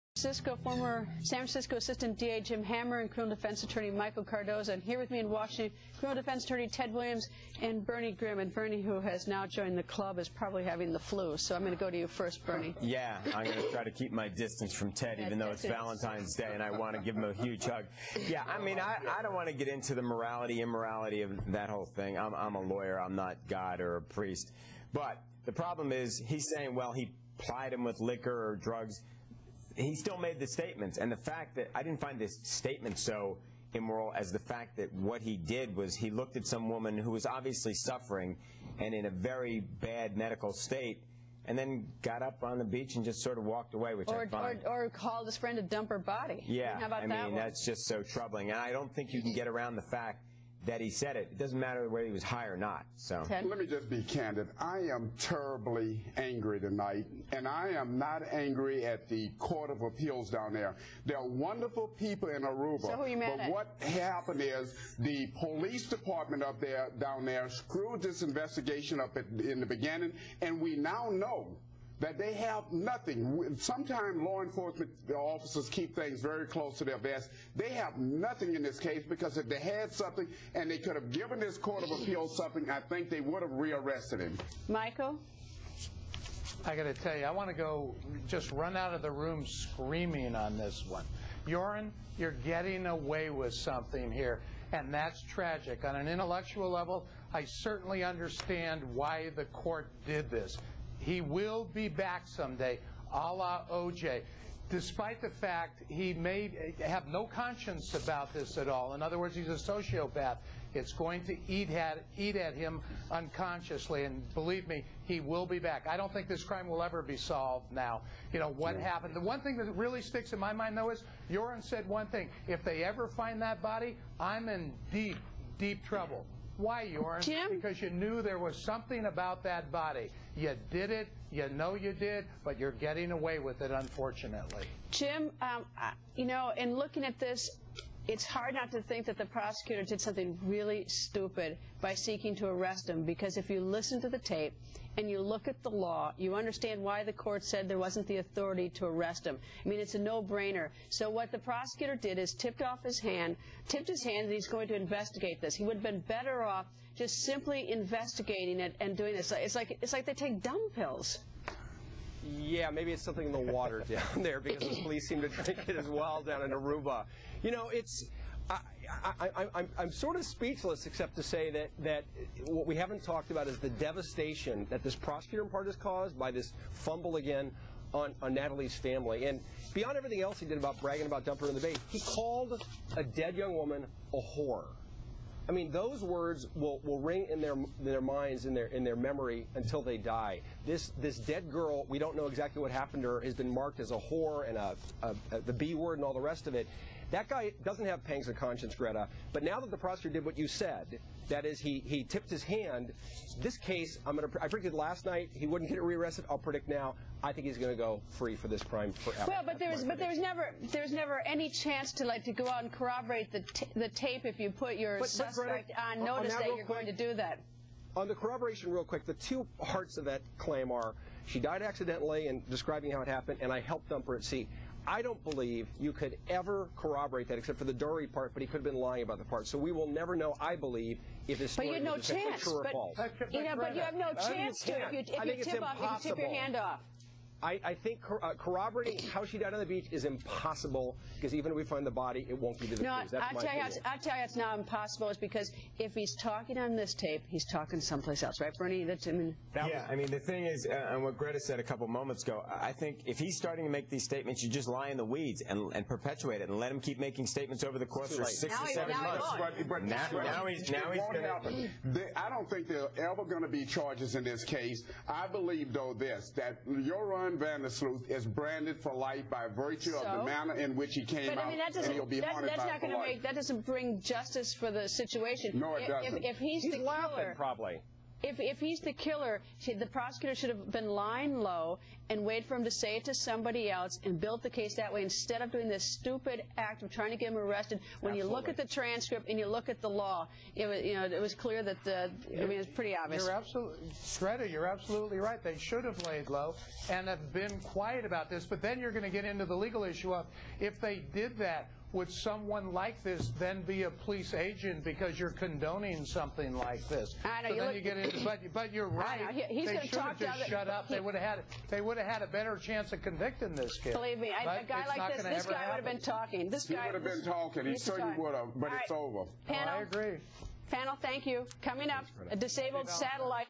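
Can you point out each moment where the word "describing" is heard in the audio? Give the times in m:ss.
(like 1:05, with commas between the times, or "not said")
3:42.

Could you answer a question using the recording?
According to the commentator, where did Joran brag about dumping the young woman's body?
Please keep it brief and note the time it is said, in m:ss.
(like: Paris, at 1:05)
in the bay, at 3:01.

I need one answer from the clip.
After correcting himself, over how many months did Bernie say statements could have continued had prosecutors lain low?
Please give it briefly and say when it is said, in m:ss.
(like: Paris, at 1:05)
7, at 4:18.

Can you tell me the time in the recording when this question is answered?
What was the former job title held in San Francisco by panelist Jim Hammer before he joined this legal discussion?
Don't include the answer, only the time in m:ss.
0:01.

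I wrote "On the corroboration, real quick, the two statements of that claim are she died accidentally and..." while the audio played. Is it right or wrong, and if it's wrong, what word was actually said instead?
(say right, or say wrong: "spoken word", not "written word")
wrong: "parts", not "statements".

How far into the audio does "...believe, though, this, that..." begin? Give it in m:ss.
4:25.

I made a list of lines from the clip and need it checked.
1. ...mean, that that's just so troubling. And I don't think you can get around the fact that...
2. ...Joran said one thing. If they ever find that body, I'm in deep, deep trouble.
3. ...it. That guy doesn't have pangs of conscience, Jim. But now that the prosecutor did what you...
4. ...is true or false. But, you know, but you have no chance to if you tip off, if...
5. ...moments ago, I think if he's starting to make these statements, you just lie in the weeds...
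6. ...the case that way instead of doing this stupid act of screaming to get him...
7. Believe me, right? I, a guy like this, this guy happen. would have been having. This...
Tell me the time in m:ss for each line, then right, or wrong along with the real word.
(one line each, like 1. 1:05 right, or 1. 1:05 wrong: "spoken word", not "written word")
1. 0:47 right
2. 2:01 right
3. 3:16 wrong: "Greta", not "Jim"
4. 3:51 right
5. 4:11 right
6. 4:44 wrong: "trying", not "screaming"
7. 5:13 wrong: "talking", not "having".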